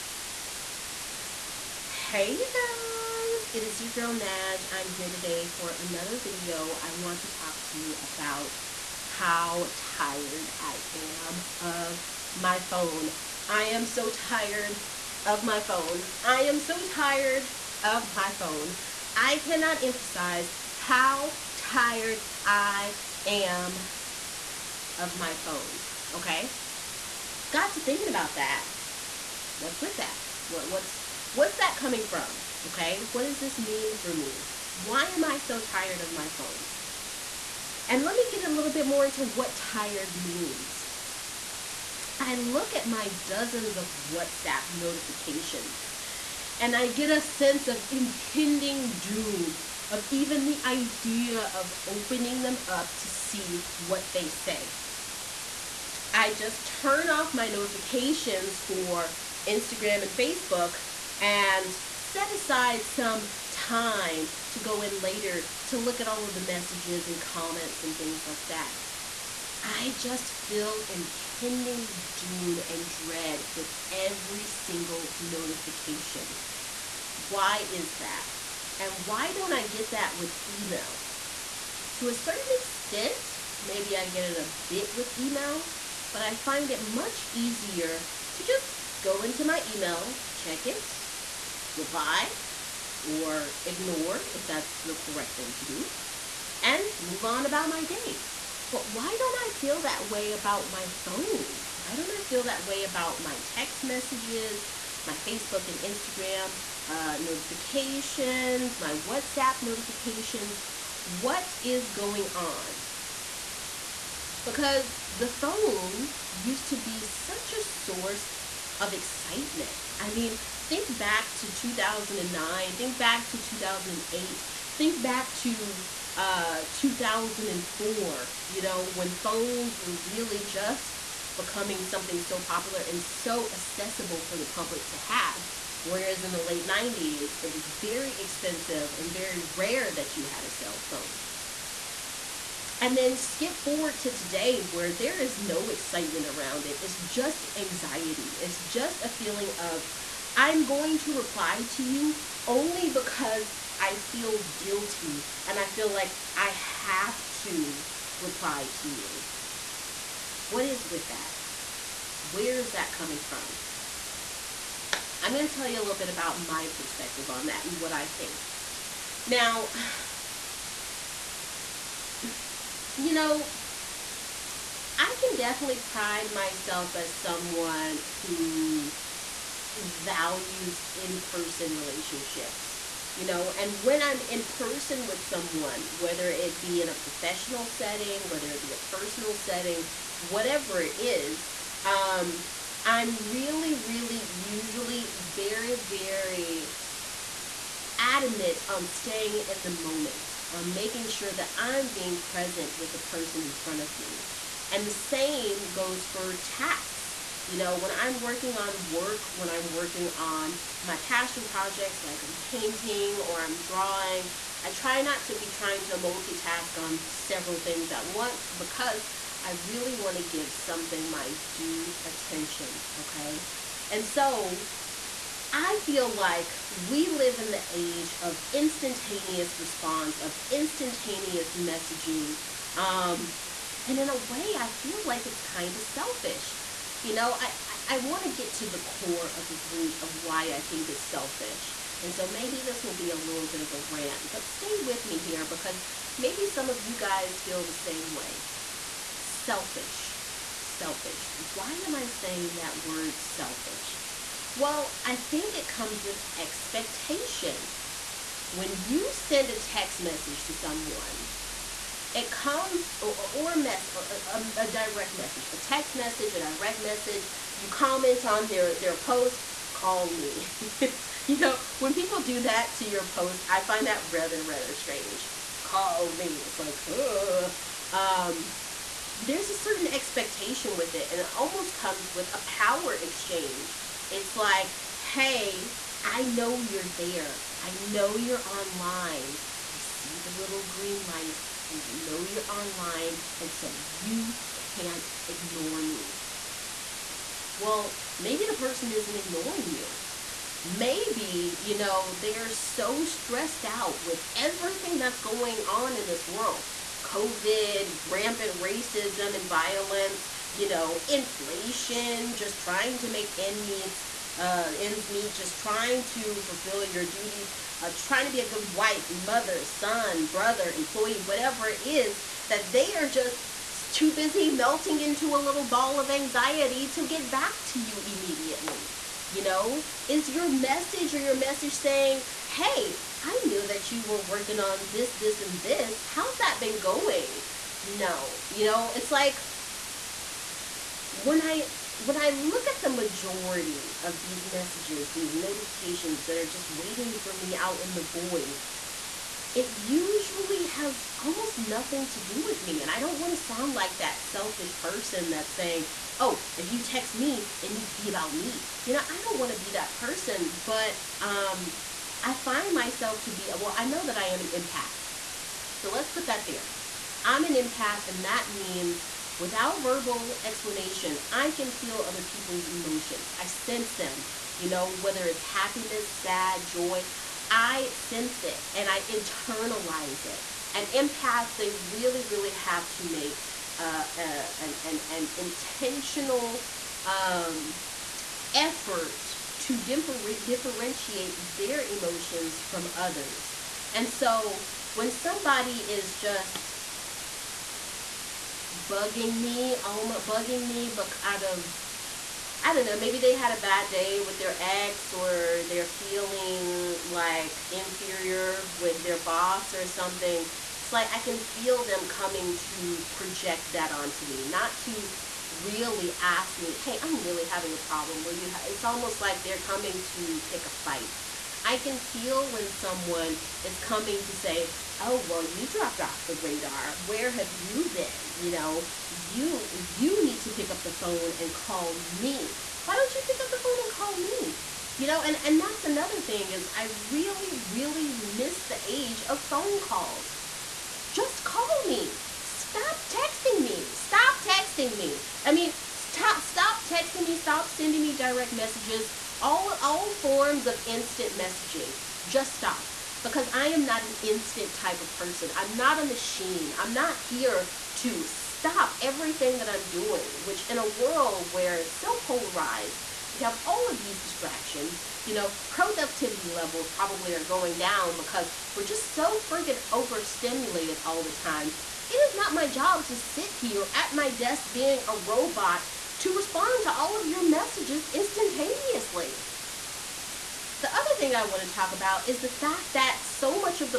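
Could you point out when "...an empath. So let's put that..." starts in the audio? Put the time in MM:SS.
06:04.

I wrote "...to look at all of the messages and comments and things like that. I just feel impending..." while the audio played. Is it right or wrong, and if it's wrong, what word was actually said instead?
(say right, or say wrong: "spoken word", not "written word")
right.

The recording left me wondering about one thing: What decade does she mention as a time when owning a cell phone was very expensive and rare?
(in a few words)
Late 90s.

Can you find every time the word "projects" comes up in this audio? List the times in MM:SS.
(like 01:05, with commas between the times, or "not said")
03:31, 06:53.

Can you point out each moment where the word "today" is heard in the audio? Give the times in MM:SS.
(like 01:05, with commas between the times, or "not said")
00:05, 02:24.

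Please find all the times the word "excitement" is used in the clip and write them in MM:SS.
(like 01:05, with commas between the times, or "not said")
01:58, 02:25.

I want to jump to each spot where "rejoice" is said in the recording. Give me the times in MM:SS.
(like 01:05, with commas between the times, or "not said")
not said.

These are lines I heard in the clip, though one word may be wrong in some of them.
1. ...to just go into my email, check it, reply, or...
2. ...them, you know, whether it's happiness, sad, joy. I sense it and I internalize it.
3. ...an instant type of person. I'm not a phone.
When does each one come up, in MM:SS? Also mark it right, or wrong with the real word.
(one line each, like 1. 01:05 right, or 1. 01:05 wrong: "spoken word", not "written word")
1. 01:28 right
2. 06:13 right
3. 07:34 wrong: "machine", not "phone".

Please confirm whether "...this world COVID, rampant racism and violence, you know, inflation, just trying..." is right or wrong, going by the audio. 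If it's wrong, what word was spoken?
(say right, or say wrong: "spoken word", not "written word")
right.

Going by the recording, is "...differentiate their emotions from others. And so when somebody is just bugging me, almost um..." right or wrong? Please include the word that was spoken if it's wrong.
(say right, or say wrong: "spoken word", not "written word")
right.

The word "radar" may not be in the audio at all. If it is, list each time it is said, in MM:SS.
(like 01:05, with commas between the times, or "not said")
07:06.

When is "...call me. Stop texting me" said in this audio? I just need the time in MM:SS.
07:21.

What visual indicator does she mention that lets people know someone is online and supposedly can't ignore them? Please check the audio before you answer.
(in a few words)
Little green light.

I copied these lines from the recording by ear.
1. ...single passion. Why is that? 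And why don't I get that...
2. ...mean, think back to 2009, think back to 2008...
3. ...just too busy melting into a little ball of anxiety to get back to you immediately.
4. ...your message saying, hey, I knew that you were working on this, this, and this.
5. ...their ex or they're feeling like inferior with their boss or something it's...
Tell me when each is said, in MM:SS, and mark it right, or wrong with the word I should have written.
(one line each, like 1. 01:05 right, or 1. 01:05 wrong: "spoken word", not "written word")
1. 01:14 wrong: "notification", not "passion"
2. 02:00 right
3. 05:23 right
4. 05:31 right
5. 06:44 right.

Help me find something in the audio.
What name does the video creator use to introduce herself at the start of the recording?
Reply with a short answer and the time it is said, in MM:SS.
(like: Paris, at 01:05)
Naj, at 00:04.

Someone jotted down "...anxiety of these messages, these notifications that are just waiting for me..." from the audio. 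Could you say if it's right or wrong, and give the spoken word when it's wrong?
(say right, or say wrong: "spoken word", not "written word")
wrong: "majority", not "anxiety".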